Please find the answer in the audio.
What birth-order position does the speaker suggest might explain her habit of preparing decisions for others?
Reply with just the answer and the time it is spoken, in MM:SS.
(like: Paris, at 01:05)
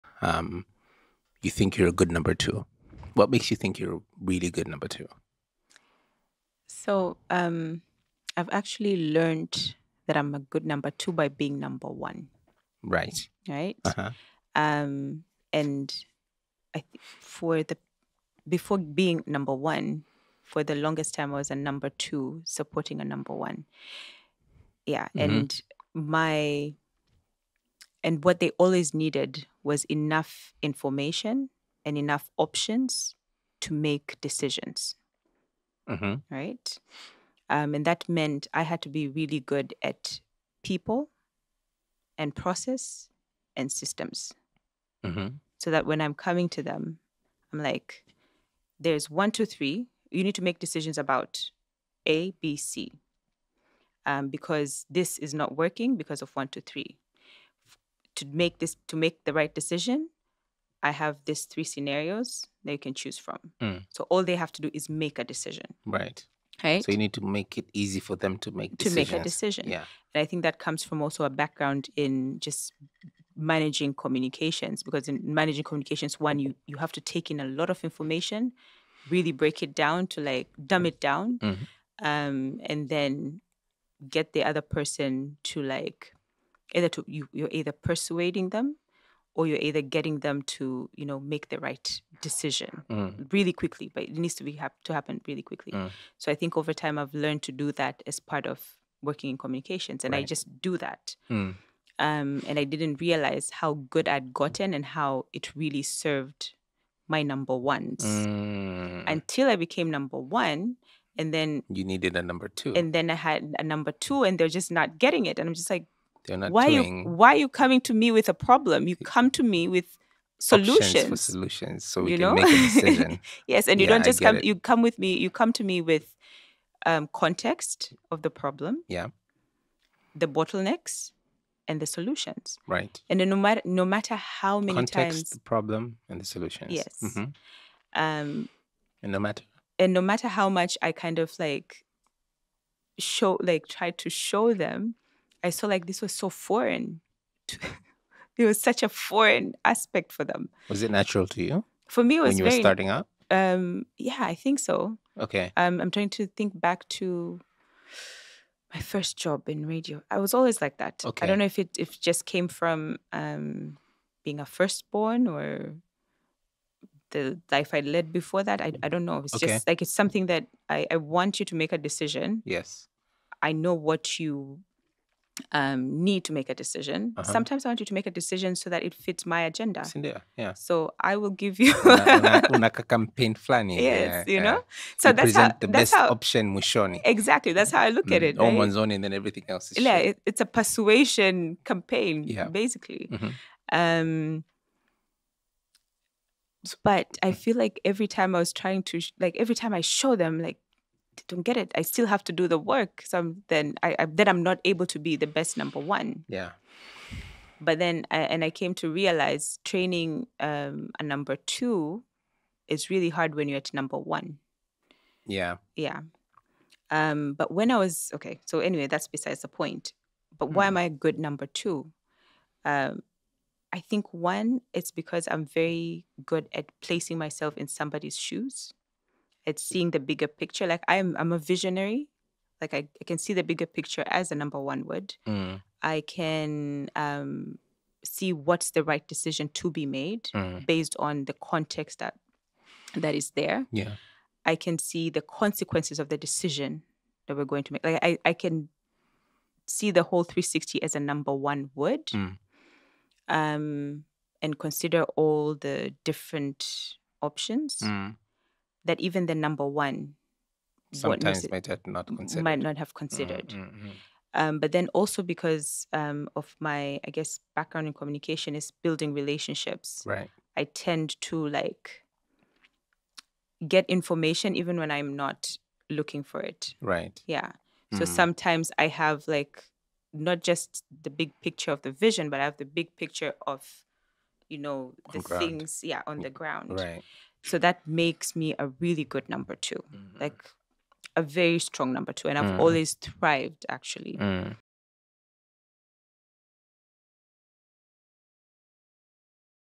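firstborn, at 02:44.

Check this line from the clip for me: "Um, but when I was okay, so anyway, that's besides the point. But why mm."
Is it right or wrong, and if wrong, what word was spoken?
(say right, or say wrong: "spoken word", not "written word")
right.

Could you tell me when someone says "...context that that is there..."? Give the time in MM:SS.
04:01.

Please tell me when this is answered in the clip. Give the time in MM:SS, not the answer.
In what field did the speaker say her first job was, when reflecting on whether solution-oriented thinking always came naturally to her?
02:39.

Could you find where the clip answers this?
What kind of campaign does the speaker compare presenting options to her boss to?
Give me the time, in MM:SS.
03:10.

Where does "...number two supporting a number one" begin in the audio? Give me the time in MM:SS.
00:21.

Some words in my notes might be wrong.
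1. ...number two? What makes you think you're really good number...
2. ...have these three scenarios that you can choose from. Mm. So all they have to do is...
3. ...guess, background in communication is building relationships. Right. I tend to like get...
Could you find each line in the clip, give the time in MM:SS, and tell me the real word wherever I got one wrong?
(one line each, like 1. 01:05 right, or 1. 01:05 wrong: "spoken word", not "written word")
1. 00:02 right
2. 01:00 right
3. 04:27 right.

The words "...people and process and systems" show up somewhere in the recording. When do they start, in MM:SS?
00:40.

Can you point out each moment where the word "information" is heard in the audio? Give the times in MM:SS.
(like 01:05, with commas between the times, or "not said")
00:30, 01:17, 04:33.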